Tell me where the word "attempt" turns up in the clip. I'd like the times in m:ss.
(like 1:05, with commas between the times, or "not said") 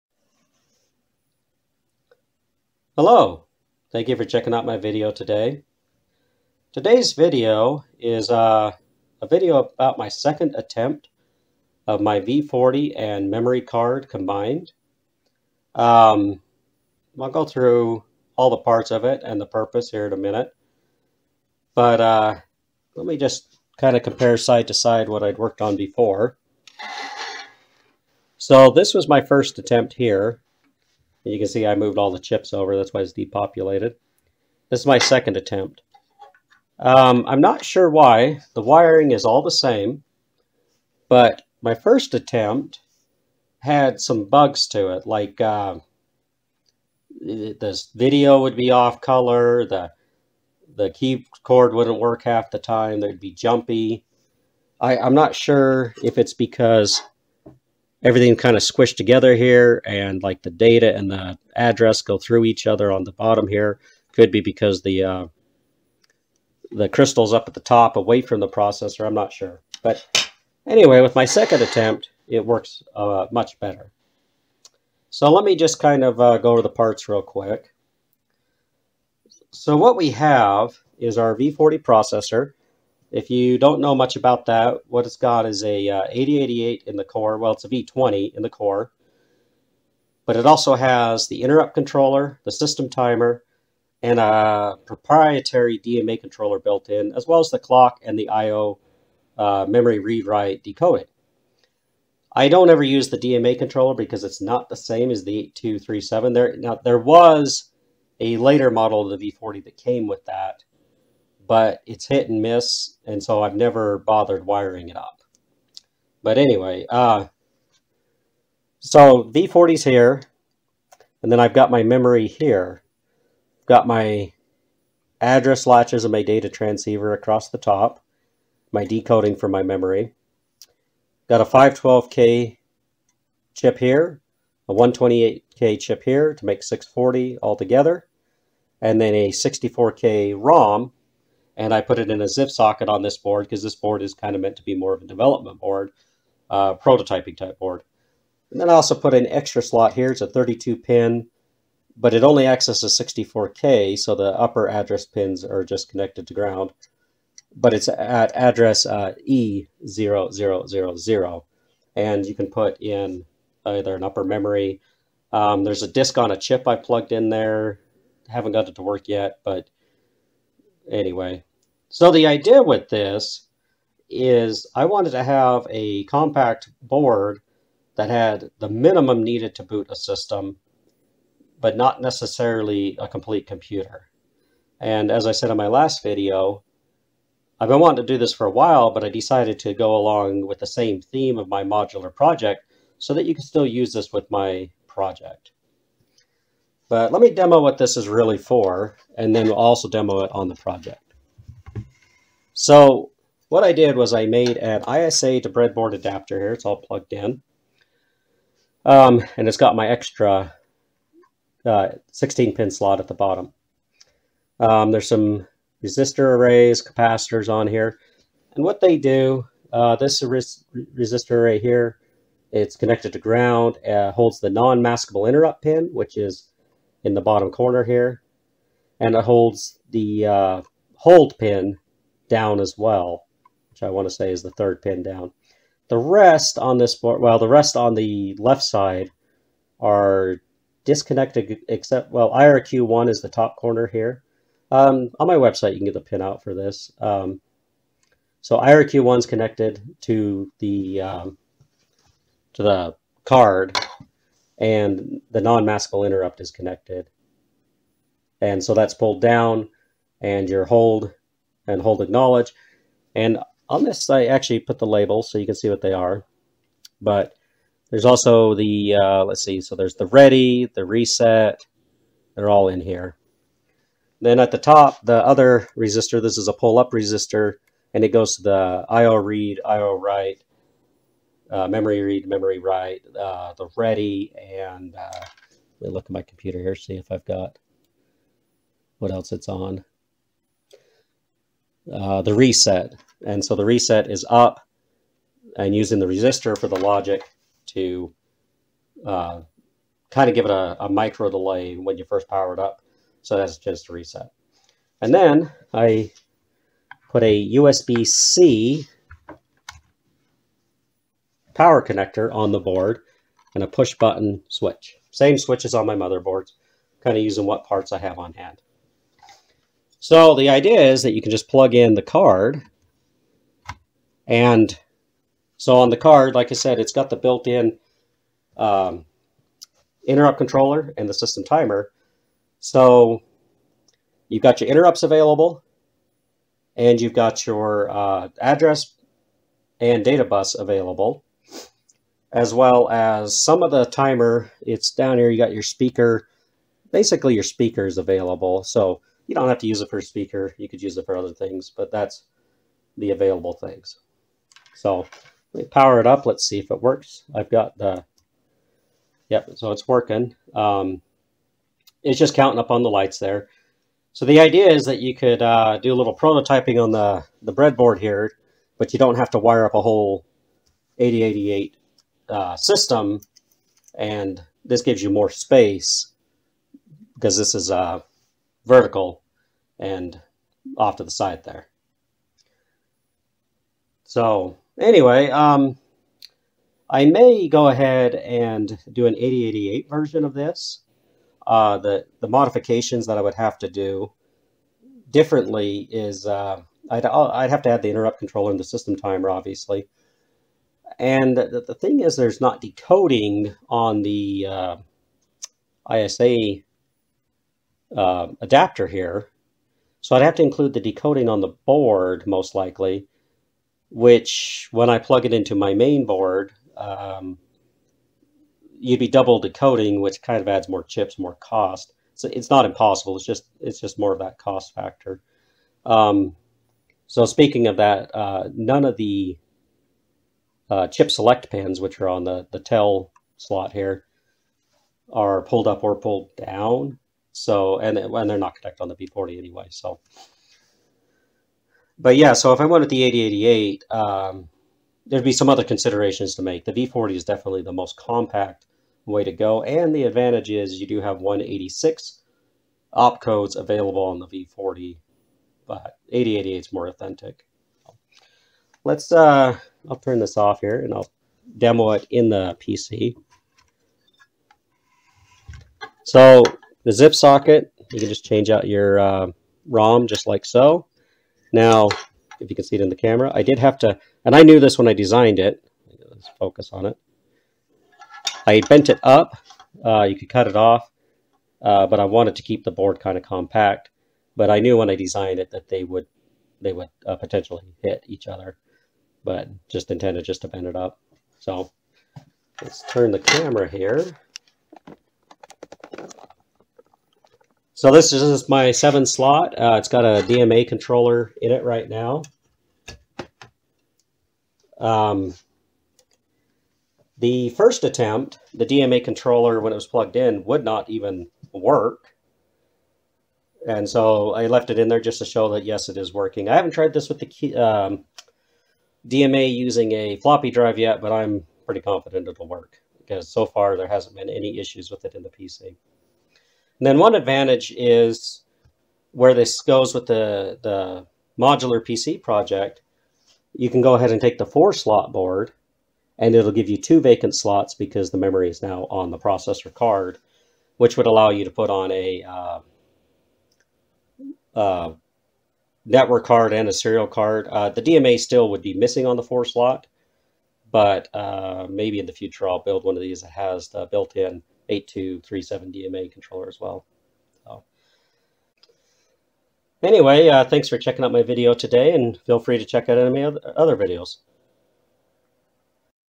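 0:10, 0:29, 0:35, 0:42, 1:11, 8:27.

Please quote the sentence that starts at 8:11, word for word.
So let's turn the camera here.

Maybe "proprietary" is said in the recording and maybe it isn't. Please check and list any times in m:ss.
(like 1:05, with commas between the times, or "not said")
1:34.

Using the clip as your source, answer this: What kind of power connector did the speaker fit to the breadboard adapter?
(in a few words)
USB-C.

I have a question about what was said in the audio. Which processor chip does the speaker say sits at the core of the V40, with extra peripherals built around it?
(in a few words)
V20.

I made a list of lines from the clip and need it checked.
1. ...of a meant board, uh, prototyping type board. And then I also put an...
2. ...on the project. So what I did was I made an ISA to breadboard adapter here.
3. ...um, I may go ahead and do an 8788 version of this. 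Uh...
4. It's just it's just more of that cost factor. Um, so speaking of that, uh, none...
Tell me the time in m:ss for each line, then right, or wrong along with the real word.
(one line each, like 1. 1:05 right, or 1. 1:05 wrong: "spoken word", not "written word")
1. 2:24 wrong: "development", not "meant"
2. 3:20 right
3. 6:25 wrong: "8088", not "8788"
4. 7:03 right.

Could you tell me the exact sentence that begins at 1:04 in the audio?
Could be because the uh, the crystals up at the top away from the processor.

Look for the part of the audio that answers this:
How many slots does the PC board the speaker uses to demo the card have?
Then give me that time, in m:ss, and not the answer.
8:18.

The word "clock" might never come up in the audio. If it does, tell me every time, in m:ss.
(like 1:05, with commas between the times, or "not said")
1:37.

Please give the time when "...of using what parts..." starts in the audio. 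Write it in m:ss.
5:17.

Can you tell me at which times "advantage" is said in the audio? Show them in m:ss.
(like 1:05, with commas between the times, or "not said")
7:30, 8:47.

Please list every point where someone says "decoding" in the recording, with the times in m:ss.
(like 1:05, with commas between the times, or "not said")
1:40, 2:08, 6:42, 6:50, 6:59.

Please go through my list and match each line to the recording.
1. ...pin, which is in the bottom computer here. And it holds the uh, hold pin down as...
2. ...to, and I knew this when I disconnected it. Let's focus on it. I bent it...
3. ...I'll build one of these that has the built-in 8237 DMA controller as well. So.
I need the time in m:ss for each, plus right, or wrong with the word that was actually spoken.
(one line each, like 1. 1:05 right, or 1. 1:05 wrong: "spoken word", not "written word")
1. 3:45 wrong: "corner", not "computer"
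2. 7:53 wrong: "designed", not "disconnected"
3. 9:12 right.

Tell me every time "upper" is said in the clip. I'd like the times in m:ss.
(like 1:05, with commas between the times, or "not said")
2:34, 2:44.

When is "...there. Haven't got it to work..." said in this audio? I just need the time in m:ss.
2:47.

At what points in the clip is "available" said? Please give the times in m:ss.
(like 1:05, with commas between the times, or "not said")
5:35, 5:40, 5:47, 5:53, 7:33.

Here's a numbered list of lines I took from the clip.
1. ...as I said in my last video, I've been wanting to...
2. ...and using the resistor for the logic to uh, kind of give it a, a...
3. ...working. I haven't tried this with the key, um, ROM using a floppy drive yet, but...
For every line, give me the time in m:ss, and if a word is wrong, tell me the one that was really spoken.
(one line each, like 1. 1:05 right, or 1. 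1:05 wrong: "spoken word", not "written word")
1. 3:05 right
2. 4:55 right
3. 8:36 wrong: "DMA", not "ROM".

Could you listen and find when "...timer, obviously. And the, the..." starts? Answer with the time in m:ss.
6:38.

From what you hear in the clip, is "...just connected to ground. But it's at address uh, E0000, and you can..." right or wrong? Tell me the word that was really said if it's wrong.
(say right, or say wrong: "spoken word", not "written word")
right.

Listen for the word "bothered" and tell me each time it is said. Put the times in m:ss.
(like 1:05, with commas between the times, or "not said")
1:53.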